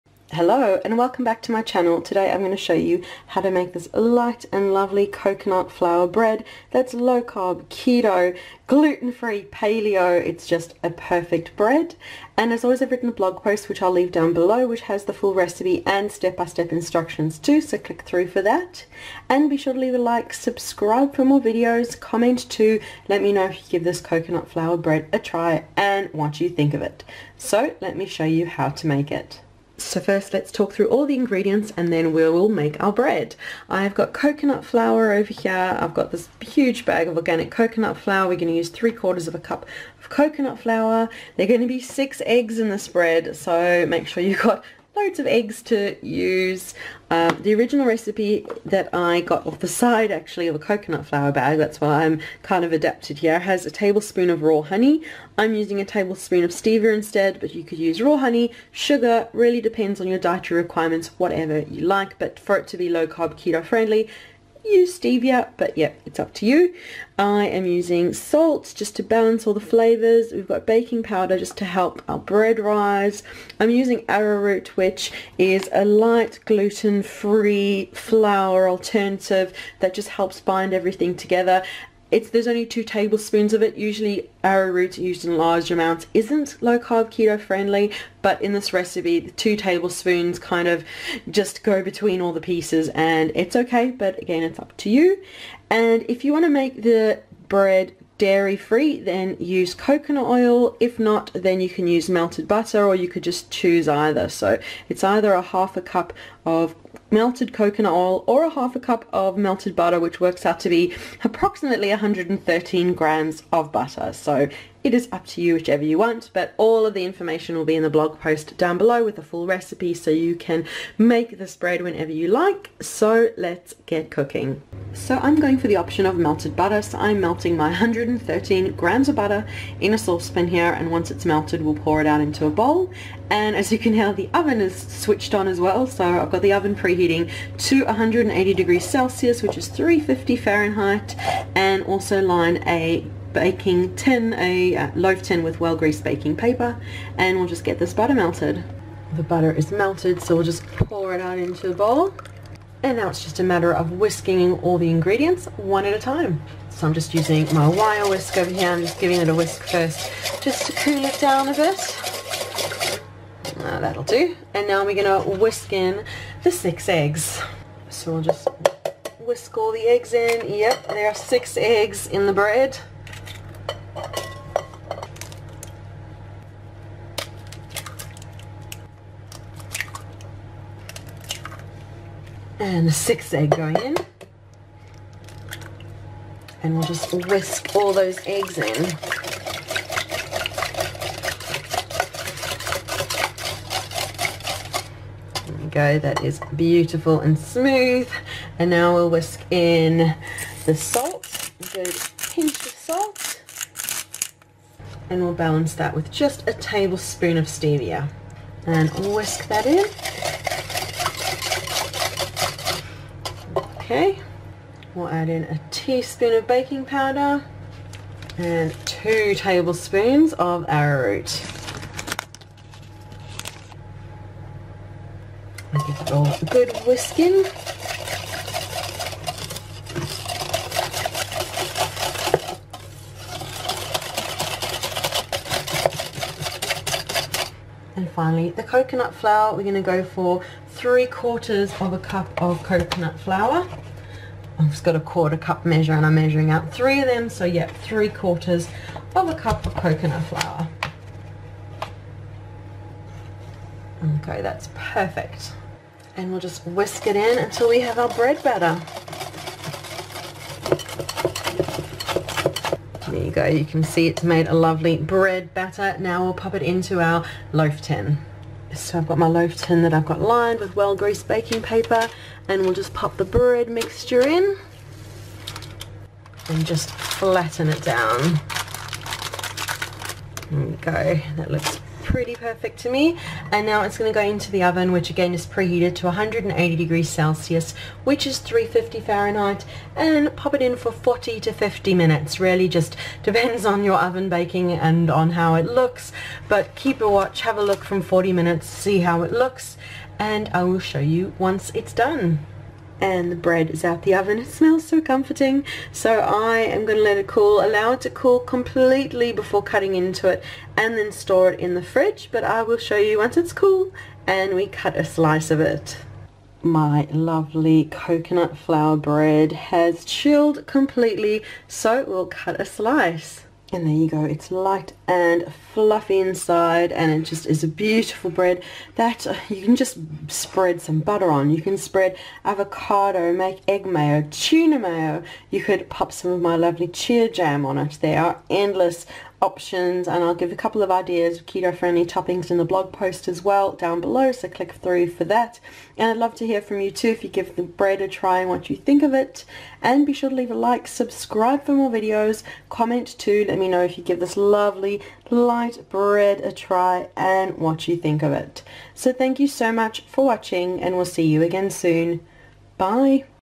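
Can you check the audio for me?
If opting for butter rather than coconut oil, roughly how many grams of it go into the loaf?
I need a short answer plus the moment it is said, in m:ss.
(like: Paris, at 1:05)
113 grams, at 1:51.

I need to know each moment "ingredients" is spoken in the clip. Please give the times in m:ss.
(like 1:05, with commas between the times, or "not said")
0:31, 2:34.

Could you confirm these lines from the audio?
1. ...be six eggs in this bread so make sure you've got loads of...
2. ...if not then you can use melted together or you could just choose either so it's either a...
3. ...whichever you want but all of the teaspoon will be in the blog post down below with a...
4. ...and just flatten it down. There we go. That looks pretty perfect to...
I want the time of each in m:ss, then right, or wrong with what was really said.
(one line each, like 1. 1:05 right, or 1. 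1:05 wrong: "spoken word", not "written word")
1. 0:41 right
2. 1:40 wrong: "butter", not "together"
3. 1:55 wrong: "information", not "teaspoon"
4. 4:36 right.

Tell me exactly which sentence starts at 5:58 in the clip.
So thank you so much for watching and we'll see you again soon.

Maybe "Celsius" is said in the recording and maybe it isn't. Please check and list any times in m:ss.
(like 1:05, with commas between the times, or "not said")
2:18, 4:47.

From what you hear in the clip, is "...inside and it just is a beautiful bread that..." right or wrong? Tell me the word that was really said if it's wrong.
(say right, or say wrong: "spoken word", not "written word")
right.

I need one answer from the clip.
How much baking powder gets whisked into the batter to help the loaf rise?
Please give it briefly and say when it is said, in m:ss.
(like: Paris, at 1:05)
a teaspoon, at 3:35.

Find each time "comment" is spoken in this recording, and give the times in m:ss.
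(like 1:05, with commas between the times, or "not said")
0:21, 5:52.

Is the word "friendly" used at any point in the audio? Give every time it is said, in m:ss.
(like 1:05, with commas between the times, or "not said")
1:03, 1:27, 5:41.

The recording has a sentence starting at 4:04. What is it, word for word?
I've just got a quarter cup measure and I'm measuring out three of them.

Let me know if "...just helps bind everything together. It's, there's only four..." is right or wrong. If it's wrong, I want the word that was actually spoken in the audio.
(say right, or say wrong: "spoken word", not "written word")
wrong: "two", not "four".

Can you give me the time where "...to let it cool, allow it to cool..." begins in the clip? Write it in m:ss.
5:06.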